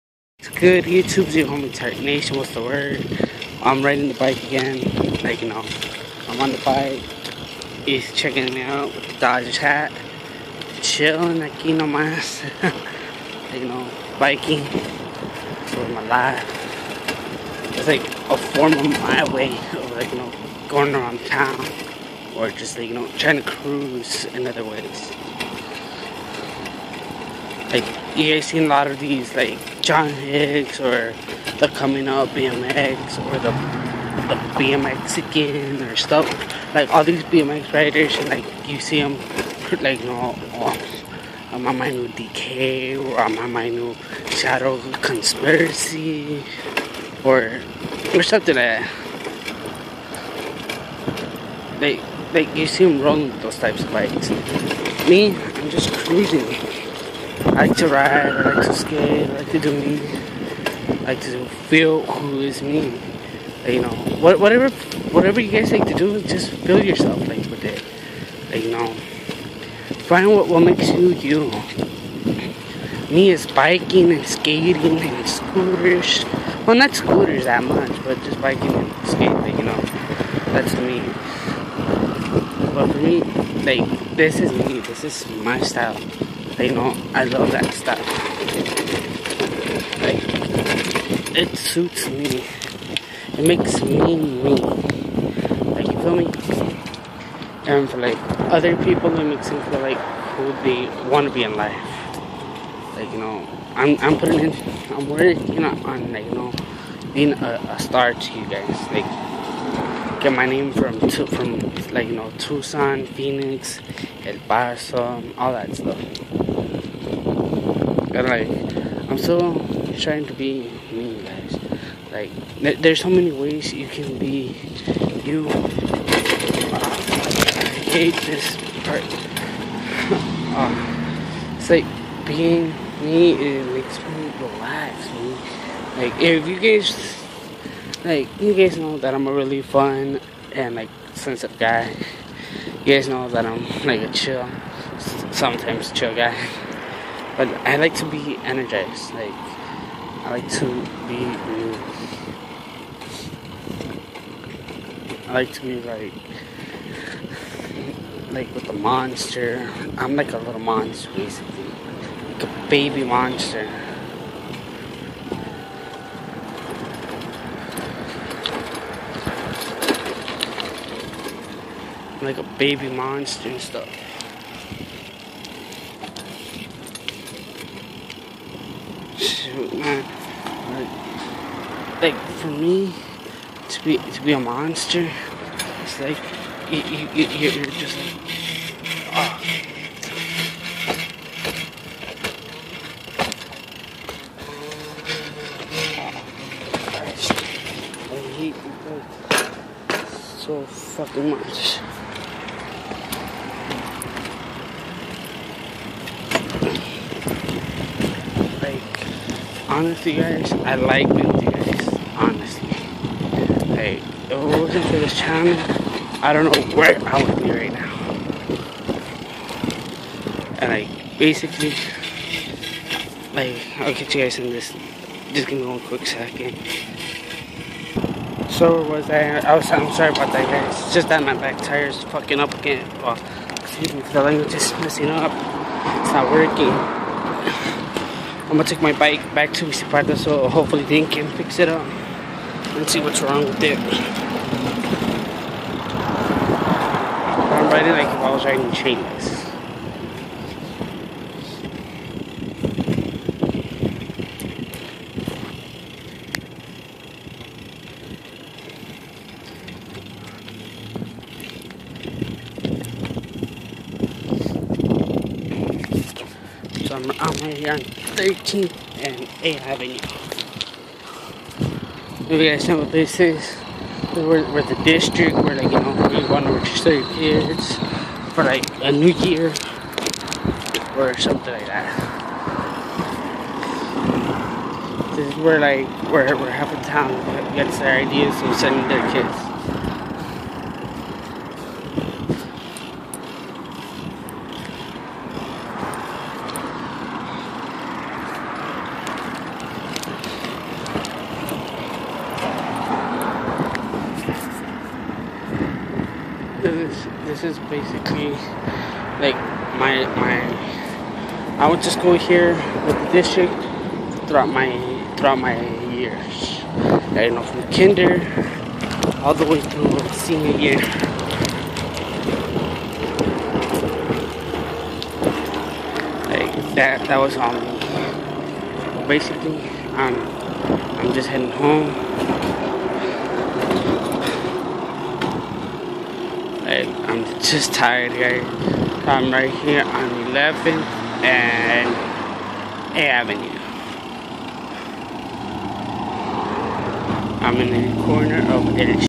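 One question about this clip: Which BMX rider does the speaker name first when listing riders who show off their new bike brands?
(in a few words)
John Hicks.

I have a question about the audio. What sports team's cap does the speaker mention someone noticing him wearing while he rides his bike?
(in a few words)
Dodgers.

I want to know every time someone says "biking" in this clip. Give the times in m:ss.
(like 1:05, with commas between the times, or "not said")
0:14, 1:13, 1:18.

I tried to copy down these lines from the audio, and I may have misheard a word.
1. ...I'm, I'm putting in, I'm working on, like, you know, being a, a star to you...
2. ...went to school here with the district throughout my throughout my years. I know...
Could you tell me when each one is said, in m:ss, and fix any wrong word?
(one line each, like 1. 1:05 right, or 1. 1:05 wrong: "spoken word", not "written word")
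1. 1:43 right
2. 5:11 right.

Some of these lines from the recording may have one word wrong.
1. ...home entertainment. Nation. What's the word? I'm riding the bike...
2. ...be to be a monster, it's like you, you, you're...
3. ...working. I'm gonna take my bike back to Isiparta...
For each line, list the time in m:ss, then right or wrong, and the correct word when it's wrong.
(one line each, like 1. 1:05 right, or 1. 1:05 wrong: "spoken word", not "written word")
1. 0:01 right
2. 3:03 right
3. 3:56 right.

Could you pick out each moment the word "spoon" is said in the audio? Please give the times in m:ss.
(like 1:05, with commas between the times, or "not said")
not said.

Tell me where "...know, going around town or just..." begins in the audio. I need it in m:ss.
0:20.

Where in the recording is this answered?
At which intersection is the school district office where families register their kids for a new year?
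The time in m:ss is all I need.
4:28.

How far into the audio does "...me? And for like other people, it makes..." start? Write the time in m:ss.
1:36.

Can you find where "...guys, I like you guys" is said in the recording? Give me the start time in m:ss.
3:30.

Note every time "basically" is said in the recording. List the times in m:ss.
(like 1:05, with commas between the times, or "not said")
2:41, 3:41, 5:07, 5:29.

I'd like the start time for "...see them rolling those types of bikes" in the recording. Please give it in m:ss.
0:52.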